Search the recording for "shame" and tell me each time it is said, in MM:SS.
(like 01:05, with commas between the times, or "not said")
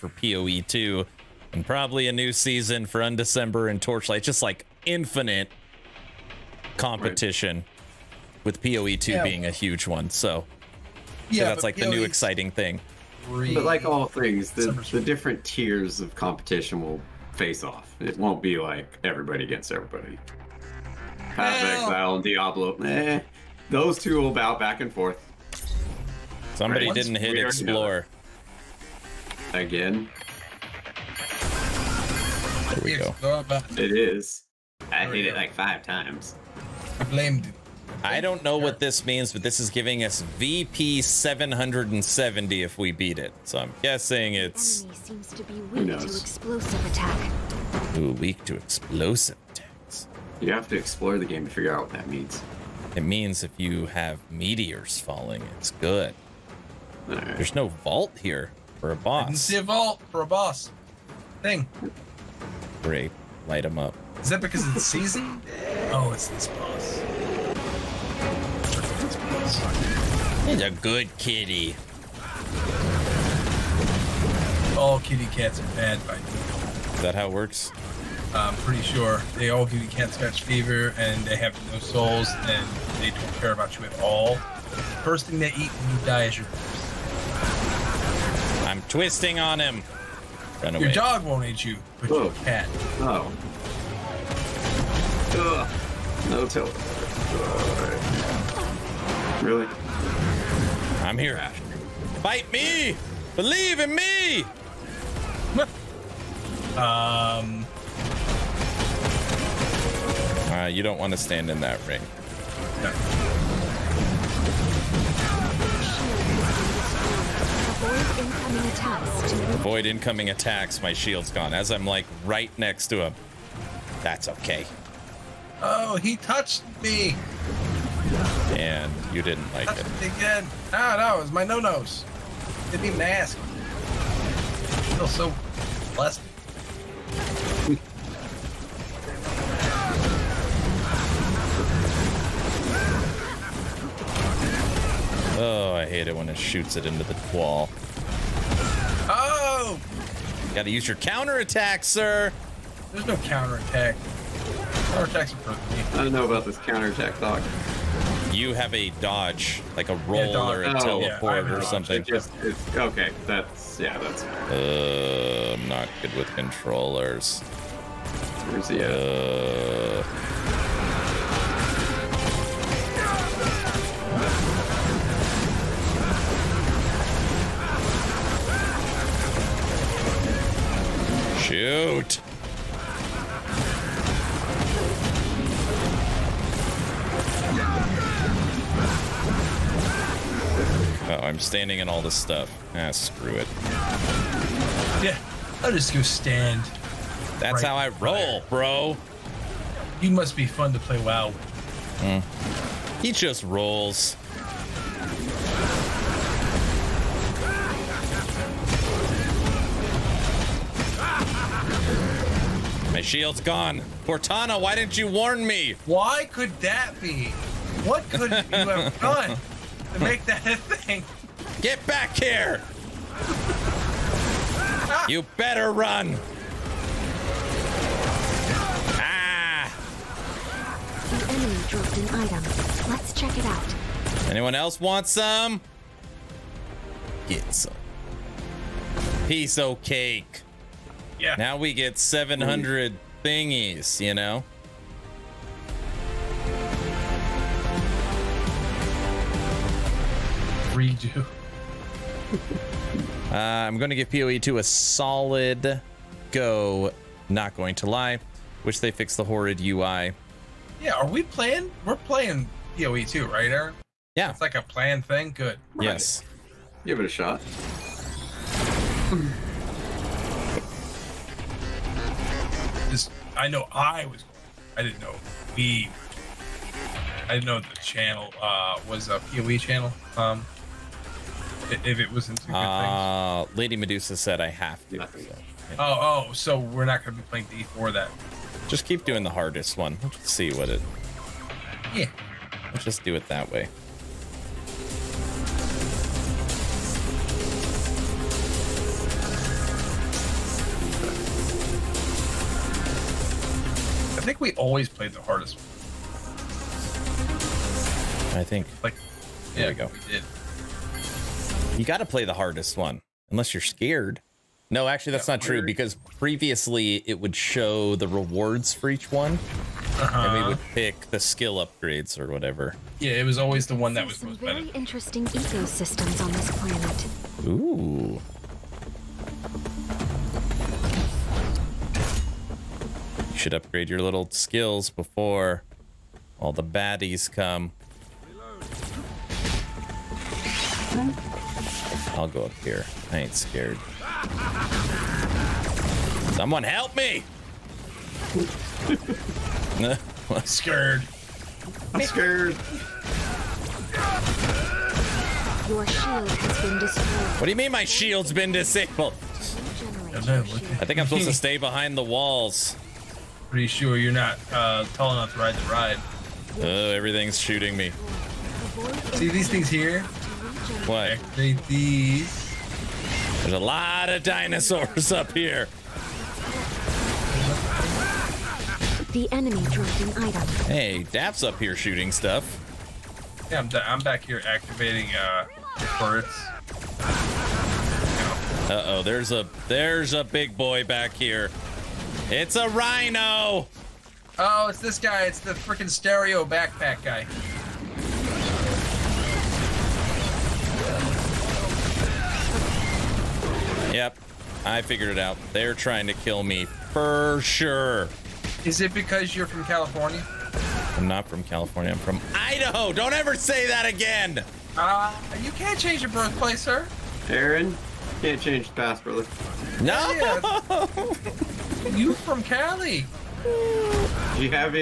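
not said.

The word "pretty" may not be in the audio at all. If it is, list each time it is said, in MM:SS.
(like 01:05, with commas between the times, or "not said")
01:18, 06:03.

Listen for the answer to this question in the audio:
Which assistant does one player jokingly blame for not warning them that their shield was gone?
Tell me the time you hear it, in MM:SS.
03:34.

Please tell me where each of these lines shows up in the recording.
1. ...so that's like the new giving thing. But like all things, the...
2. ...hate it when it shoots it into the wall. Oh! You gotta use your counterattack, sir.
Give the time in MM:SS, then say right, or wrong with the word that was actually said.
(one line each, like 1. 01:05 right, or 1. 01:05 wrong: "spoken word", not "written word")
1. 00:11 wrong: "exciting", not "giving"
2. 02:25 right.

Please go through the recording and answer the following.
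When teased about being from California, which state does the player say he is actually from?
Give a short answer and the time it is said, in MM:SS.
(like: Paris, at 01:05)
Idaho, at 06:52.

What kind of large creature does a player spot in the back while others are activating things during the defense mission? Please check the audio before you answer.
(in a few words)
A rhino.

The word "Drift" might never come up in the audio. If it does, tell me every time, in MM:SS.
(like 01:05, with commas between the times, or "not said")
not said.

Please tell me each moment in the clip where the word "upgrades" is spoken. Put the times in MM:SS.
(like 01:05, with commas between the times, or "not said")
05:21, 05:33.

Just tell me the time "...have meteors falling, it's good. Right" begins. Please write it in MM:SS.
00:53.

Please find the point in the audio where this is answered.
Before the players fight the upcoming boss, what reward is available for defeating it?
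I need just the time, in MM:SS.
00:40.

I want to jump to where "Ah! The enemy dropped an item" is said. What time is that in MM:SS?
03:48.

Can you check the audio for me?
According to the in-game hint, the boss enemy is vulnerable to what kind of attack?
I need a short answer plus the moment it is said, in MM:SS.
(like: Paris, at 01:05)
explosive attacks, at 00:48.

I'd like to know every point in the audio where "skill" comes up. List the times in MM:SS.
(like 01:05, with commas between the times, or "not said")
05:21, 05:34.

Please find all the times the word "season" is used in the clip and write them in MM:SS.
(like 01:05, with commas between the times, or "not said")
00:02, 01:04.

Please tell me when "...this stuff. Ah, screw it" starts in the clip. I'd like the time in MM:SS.
03:12.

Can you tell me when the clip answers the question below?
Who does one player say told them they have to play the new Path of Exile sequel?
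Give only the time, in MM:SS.
04:43.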